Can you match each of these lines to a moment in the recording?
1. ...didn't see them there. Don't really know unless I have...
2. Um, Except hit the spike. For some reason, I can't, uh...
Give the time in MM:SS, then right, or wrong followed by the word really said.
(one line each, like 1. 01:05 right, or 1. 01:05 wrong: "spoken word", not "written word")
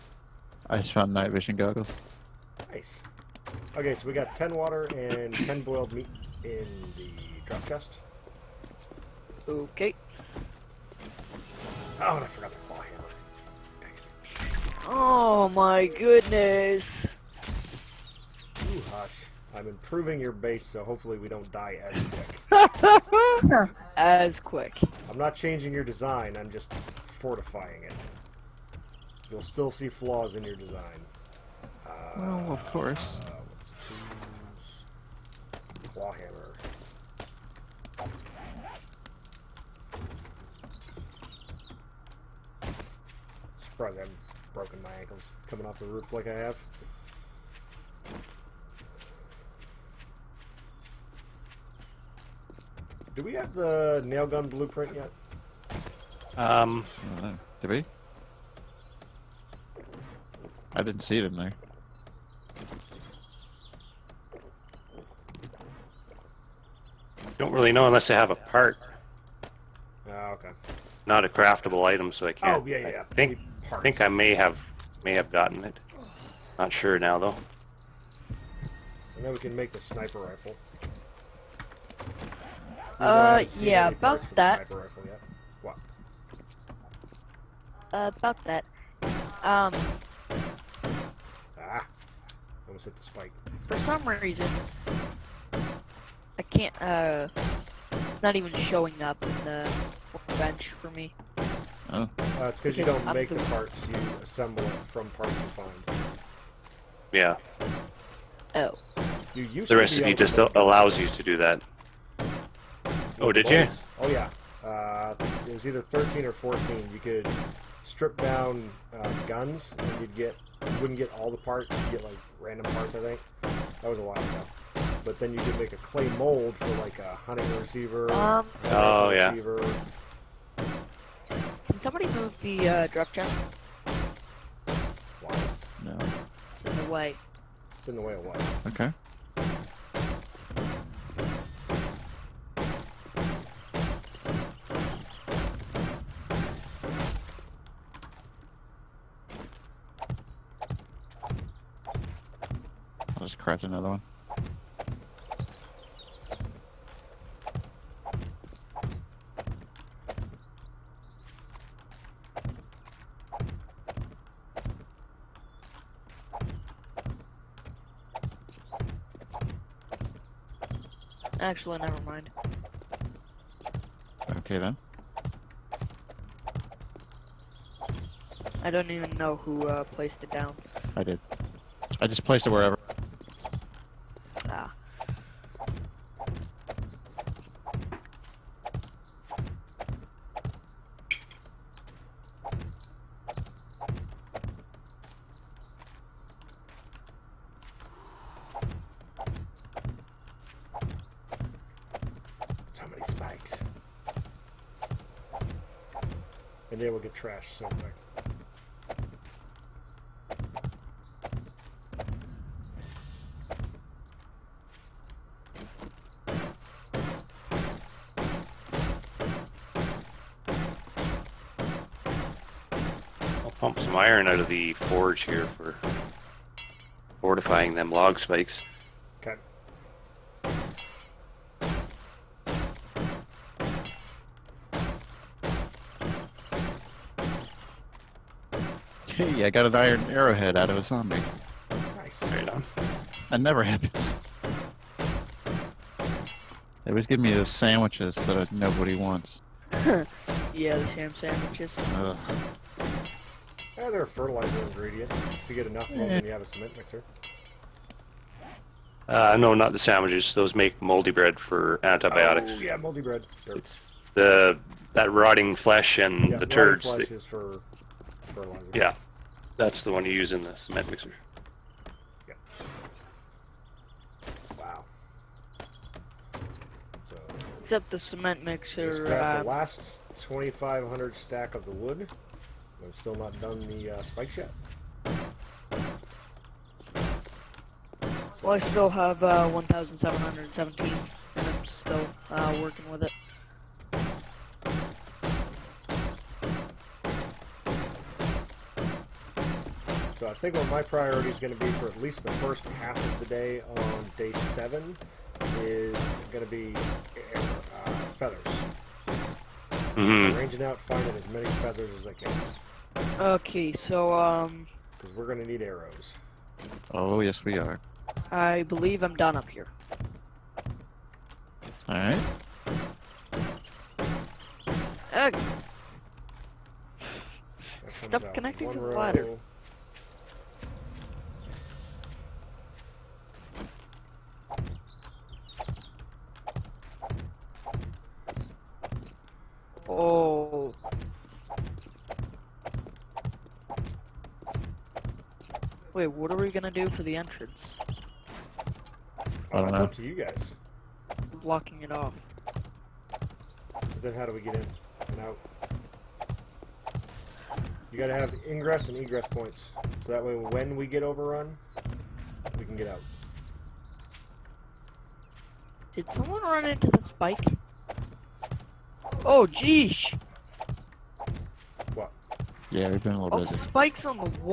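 1. 01:00 right
2. 01:29 wrong: "Almost", not "Except".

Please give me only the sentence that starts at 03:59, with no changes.
Hey, I got an iron arrowhead out of a zombie.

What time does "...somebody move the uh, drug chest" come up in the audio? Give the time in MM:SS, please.
02:11.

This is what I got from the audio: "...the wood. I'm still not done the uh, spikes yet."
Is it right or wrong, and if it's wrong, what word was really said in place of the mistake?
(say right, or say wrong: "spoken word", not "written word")
right.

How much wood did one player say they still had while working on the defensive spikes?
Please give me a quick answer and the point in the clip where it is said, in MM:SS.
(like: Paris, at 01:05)
1,717, at 04:49.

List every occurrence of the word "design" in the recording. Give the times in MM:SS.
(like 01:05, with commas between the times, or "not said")
00:25, 00:30.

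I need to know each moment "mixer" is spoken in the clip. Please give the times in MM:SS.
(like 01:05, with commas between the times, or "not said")
04:16, 04:30, 04:38.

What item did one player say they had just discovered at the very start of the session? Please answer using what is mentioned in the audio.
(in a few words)
night vision goggles.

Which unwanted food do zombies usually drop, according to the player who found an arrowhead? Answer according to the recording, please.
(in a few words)
ham sandwiches.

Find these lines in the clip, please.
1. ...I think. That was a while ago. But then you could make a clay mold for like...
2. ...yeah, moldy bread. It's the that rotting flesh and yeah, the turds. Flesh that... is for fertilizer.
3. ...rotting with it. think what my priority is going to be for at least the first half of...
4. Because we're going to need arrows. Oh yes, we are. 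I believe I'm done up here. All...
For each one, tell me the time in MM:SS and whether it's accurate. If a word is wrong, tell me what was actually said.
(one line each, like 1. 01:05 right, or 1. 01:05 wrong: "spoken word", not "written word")
1. 02:02 right
2. 04:22 right
3. 04:52 wrong: "working", not "rotting"
4. 05:14 right.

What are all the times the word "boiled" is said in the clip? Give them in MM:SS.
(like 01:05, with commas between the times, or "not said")
00:05.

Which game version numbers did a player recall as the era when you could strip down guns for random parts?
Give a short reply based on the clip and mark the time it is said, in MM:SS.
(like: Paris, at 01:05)
13 or 14, at 01:55.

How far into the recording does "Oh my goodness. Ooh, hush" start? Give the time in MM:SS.
00:14.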